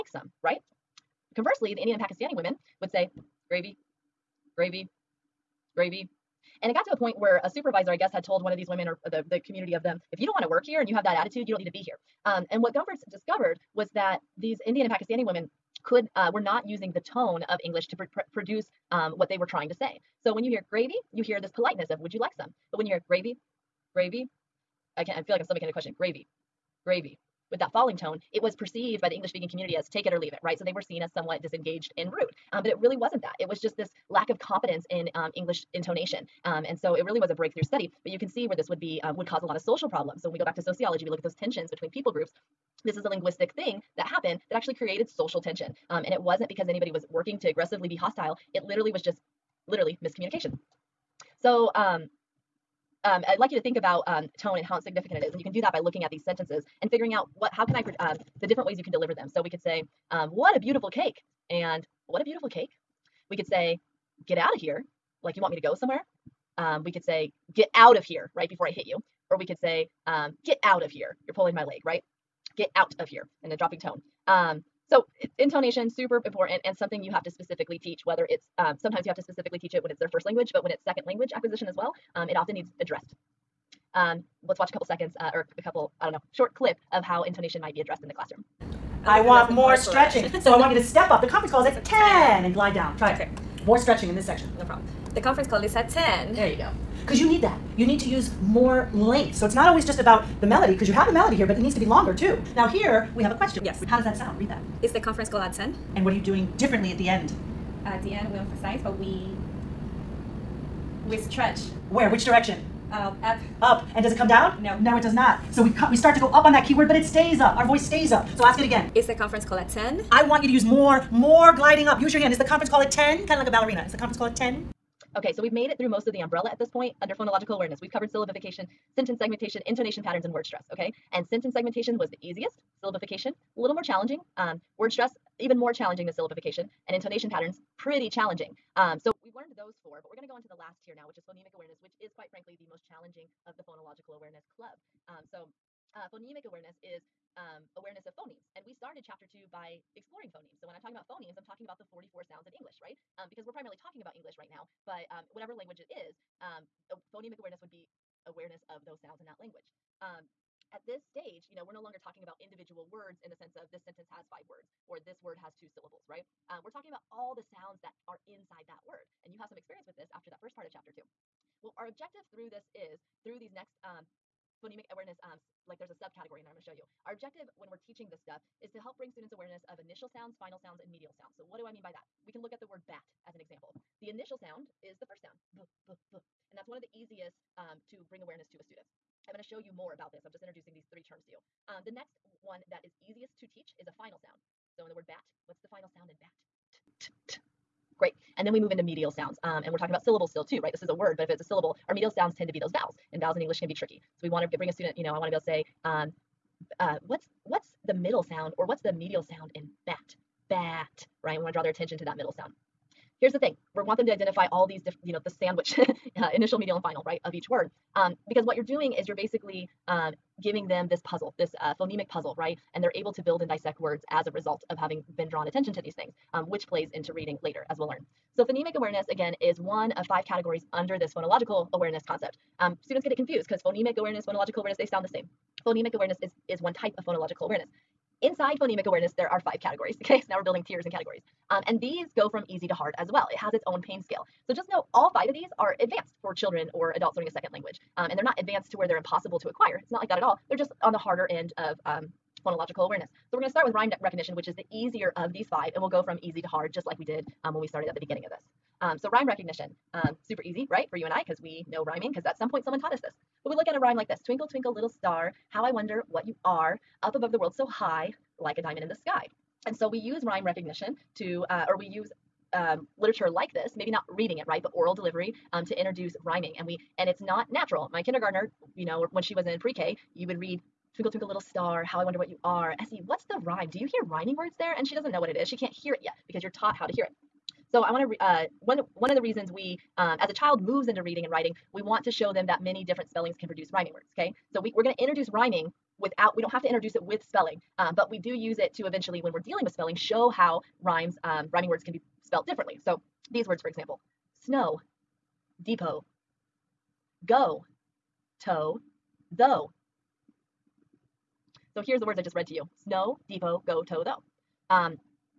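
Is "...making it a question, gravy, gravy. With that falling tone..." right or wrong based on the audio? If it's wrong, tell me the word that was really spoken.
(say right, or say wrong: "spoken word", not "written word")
right.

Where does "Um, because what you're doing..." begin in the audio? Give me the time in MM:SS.
03:37.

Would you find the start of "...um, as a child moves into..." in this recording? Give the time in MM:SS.
04:49.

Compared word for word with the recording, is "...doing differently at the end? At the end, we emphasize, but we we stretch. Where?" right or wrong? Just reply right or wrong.
right.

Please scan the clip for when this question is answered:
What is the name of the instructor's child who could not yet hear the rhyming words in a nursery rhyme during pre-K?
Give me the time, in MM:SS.
04:42.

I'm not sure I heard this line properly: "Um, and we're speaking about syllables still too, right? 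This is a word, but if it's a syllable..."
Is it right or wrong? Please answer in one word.
wrong.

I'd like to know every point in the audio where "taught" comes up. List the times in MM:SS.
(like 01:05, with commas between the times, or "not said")
04:22, 04:46.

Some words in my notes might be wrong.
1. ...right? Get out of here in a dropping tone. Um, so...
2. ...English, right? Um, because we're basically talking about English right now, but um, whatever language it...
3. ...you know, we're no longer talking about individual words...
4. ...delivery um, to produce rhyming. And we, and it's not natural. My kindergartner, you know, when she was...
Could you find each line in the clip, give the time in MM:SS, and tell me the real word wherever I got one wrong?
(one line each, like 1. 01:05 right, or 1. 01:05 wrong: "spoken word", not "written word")
1. 01:11 right
2. 02:32 wrong: "primarily", not "basically"
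3. 02:41 right
4. 04:34 wrong: "introduce", not "produce".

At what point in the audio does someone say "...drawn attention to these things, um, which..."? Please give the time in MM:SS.
03:45.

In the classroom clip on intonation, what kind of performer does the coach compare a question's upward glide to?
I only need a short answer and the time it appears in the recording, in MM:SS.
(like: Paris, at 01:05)
a ballerina, at 02:03.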